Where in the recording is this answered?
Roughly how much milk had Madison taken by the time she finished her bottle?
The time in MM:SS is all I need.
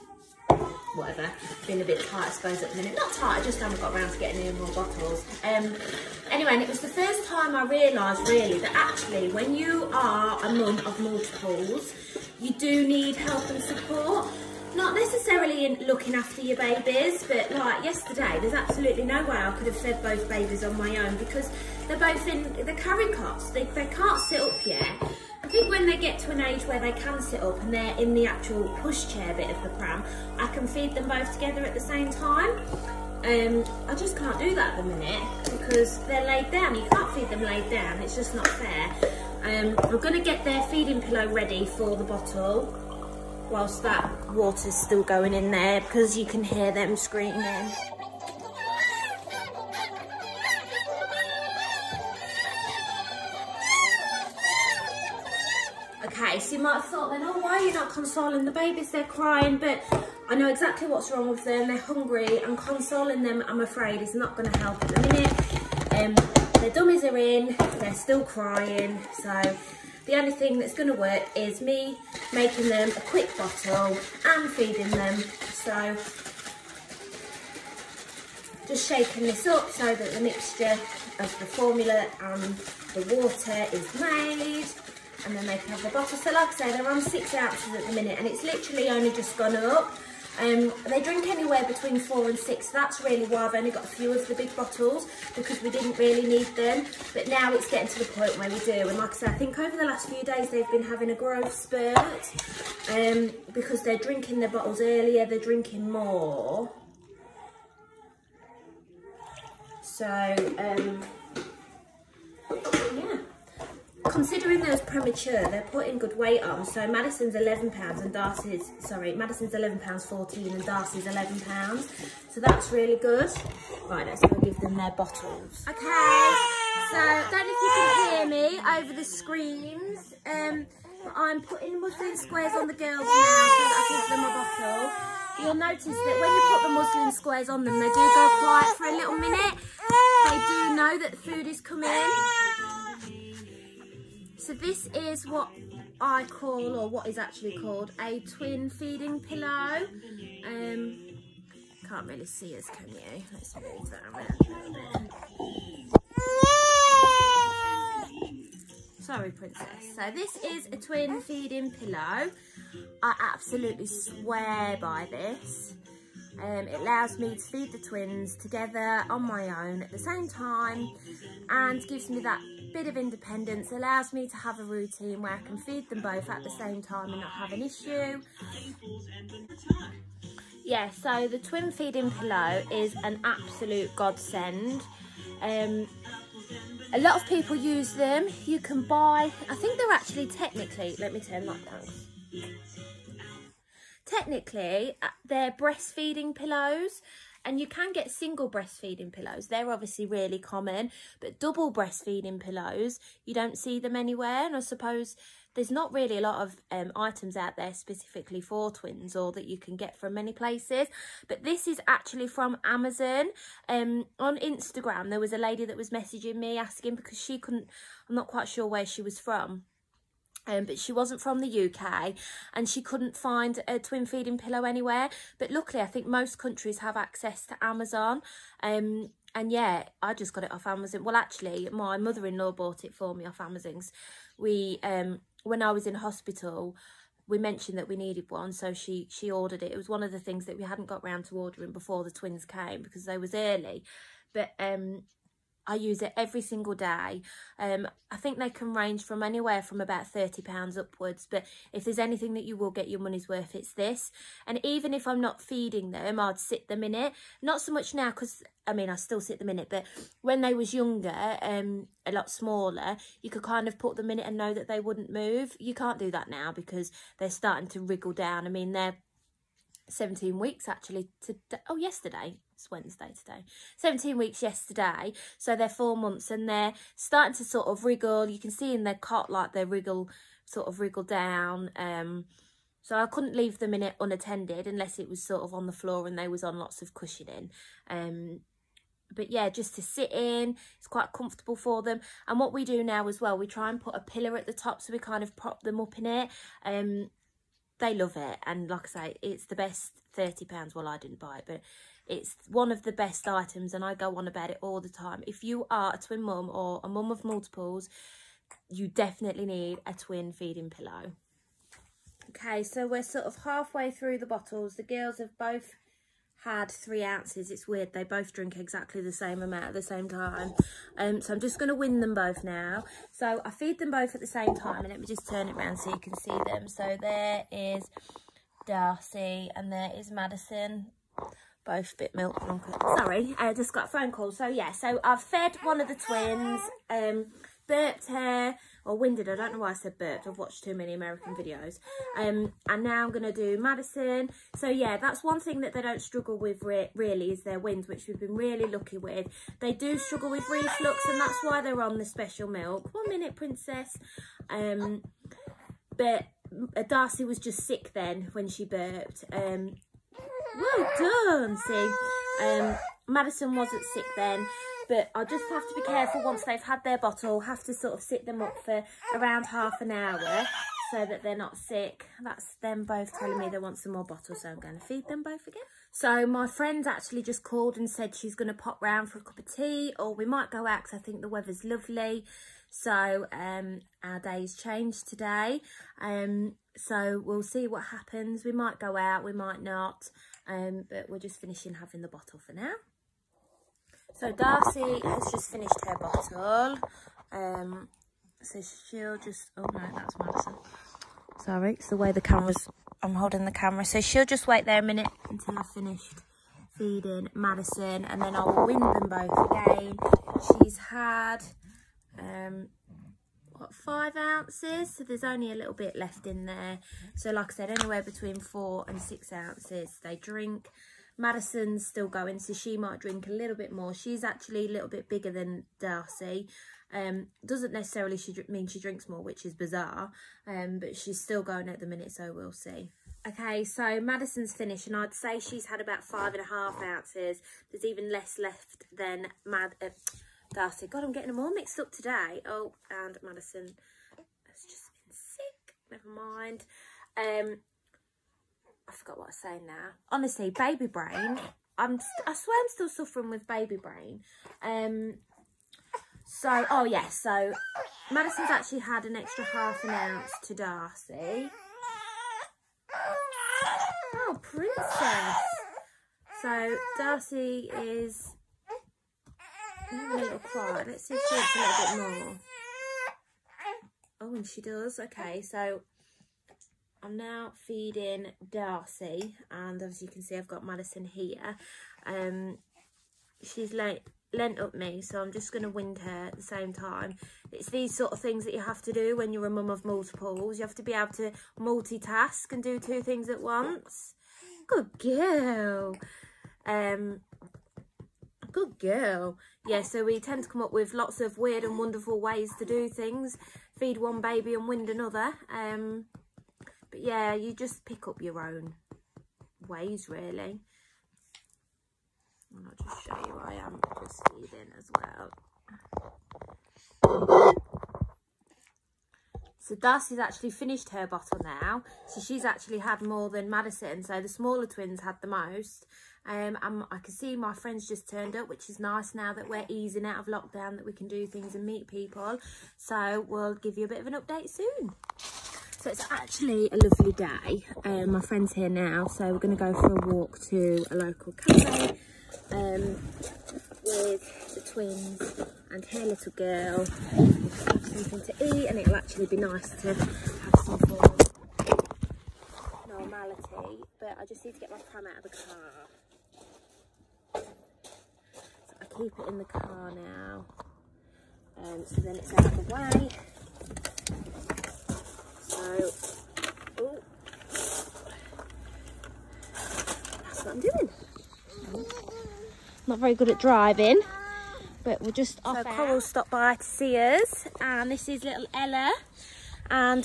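07:16.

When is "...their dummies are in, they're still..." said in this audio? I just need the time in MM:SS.
01:06.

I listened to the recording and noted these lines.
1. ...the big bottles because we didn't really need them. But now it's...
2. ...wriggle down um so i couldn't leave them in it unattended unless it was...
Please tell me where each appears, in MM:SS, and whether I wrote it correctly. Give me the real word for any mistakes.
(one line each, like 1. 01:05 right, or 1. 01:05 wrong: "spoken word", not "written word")
1. 01:34 right
2. 04:40 right.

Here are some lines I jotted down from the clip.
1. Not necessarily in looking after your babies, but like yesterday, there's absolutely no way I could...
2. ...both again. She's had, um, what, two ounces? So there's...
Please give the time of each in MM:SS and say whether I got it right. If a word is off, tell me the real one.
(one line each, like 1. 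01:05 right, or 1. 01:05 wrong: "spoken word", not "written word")
1. 00:14 right
2. 06:49 wrong: "five", not "two".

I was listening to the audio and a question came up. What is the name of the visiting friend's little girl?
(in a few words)
Ella.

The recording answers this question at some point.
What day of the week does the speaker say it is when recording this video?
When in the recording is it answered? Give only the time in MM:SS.
04:32.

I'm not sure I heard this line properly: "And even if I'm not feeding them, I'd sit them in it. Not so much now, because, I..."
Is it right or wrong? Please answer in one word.
right.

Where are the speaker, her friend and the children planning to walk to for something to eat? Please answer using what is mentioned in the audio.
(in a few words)
A local cafe.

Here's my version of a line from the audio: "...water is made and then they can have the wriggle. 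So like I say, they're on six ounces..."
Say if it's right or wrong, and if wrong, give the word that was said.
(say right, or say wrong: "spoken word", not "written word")
wrong: "bottle", not "wriggle".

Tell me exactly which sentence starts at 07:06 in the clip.
Um, doesn't necessarily she mean she drinks more, which is bizarre, um, but she's still going at the minute, so we'll see.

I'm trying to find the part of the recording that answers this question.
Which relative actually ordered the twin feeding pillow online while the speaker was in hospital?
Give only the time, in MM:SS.
03:51.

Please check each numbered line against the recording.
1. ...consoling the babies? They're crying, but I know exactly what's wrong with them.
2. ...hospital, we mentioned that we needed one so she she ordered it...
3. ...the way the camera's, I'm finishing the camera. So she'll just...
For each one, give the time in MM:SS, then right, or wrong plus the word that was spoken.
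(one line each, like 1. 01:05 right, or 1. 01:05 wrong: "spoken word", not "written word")
1. 00:57 right
2. 03:55 right
3. 06:41 wrong: "holding", not "finishing".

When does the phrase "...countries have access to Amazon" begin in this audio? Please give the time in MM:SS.
03:46.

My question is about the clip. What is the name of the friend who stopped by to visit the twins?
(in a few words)
Coral.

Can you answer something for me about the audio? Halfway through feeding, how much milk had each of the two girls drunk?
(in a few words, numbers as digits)
3 ounces.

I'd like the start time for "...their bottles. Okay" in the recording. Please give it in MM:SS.
02:04.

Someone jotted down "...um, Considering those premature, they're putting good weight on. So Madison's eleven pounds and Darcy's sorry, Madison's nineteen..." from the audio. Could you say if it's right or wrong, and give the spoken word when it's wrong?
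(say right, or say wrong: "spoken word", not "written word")
wrong: "eleven", not "nineteen".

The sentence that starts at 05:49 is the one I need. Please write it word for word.
They do struggle with reflux and that's why they're on the special milk.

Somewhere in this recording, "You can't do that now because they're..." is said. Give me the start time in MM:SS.
04:25.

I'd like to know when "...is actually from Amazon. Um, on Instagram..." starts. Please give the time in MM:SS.
03:31.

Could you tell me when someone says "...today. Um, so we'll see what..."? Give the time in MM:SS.
06:25.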